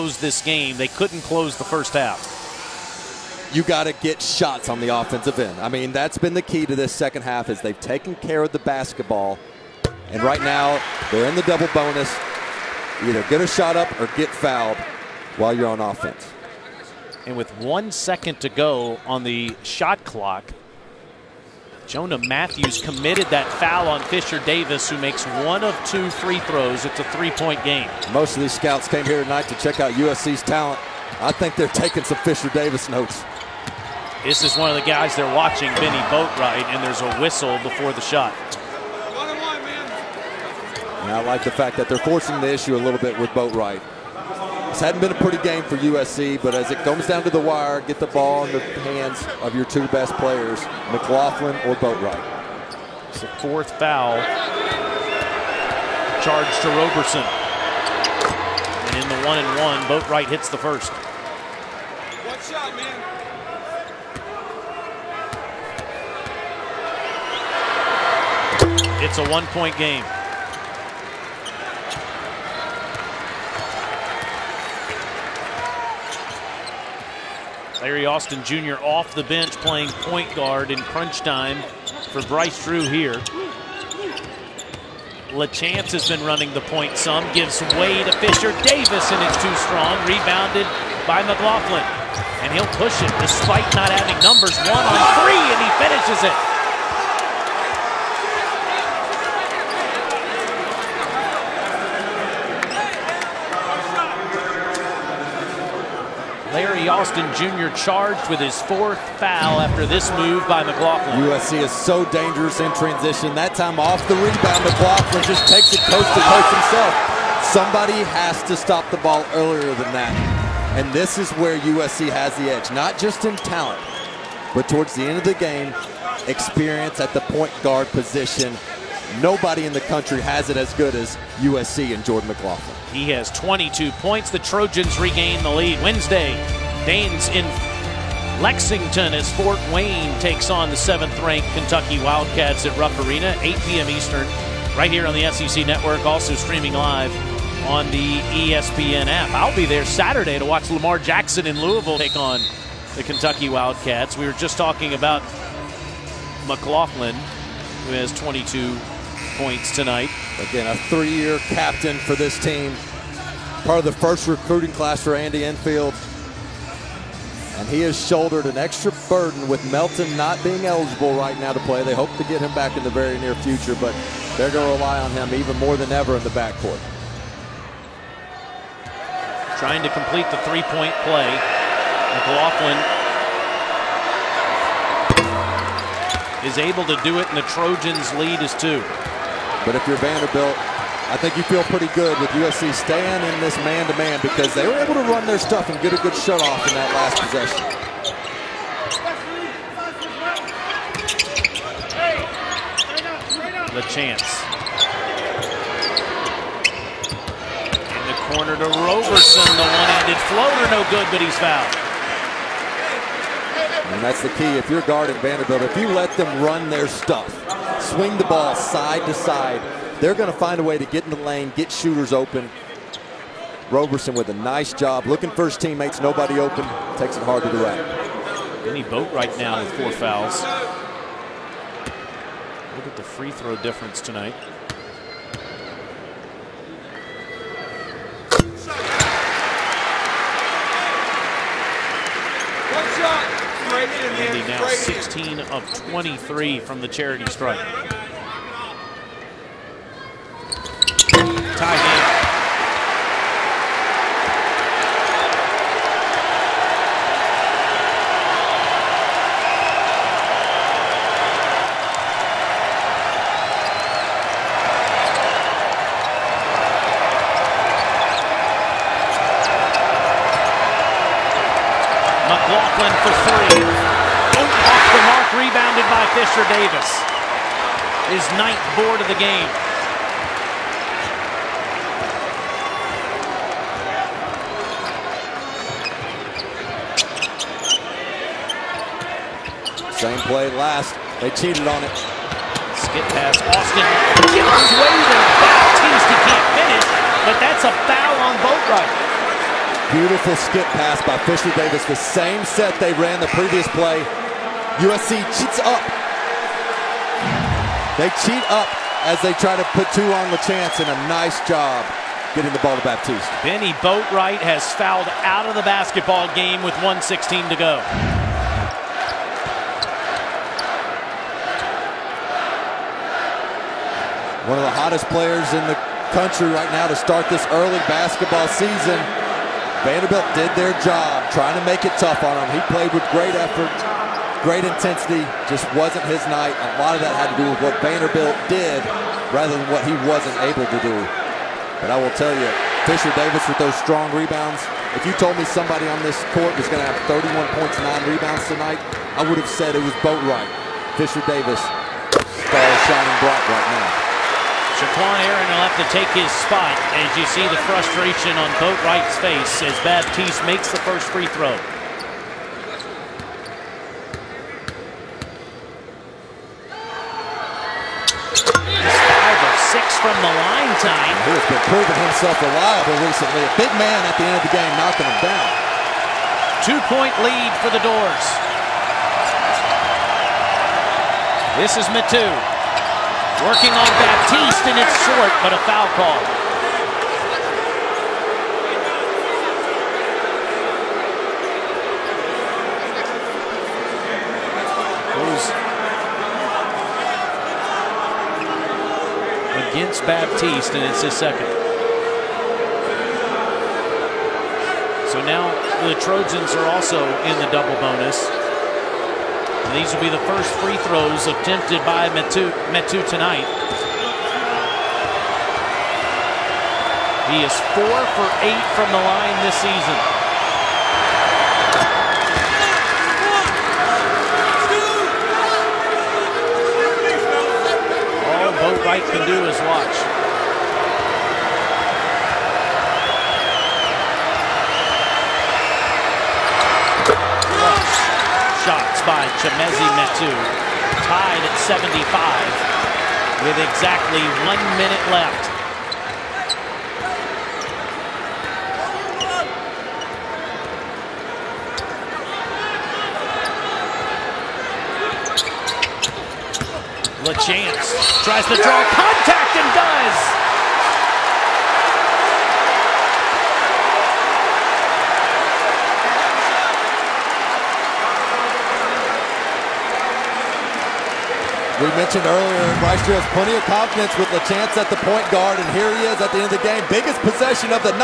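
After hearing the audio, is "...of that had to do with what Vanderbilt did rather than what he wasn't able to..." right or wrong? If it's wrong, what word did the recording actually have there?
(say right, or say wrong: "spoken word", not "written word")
right.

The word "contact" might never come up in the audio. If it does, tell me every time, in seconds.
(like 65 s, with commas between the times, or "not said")
458 s.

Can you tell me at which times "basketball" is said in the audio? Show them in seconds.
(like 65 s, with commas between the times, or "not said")
8 s, 315 s, 327 s.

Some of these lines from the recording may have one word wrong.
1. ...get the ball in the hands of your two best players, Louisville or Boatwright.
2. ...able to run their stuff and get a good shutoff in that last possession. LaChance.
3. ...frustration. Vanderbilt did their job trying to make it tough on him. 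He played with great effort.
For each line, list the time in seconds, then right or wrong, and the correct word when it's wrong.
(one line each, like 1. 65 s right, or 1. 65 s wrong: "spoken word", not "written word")
1. 47 s wrong: "McLaughlin", not "Louisville"
2. 194 s right
3. 328 s wrong: "season", not "frustration".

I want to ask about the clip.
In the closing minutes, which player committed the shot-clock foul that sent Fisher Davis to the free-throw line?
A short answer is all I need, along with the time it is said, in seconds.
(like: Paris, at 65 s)
Jonah Mathews, at 21 s.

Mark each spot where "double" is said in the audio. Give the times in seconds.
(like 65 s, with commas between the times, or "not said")
11 s, 407 s.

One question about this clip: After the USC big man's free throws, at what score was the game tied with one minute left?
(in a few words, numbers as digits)
75.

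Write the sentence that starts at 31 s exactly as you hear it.
I think they're taking some Fisher Davis notes.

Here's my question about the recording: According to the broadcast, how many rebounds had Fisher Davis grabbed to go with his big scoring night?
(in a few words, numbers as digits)
9.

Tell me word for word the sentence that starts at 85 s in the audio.
LaChance has been running the point some, gives way to Fisher Davis, and it's too strong.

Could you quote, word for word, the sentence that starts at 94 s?
One on three, and he finishes it.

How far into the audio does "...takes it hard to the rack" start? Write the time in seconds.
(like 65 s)
226 s.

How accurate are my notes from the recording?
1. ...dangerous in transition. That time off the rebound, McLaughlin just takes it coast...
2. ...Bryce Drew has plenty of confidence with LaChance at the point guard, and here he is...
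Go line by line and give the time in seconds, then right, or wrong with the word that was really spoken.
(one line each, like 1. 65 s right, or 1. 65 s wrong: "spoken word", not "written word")
1. 112 s right
2. 472 s right.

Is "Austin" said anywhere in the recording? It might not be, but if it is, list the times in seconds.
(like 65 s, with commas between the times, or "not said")
78 s, 106 s, 293 s.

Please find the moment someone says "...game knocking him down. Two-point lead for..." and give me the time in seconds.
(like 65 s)
374 s.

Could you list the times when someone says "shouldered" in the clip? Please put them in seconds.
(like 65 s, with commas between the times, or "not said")
168 s.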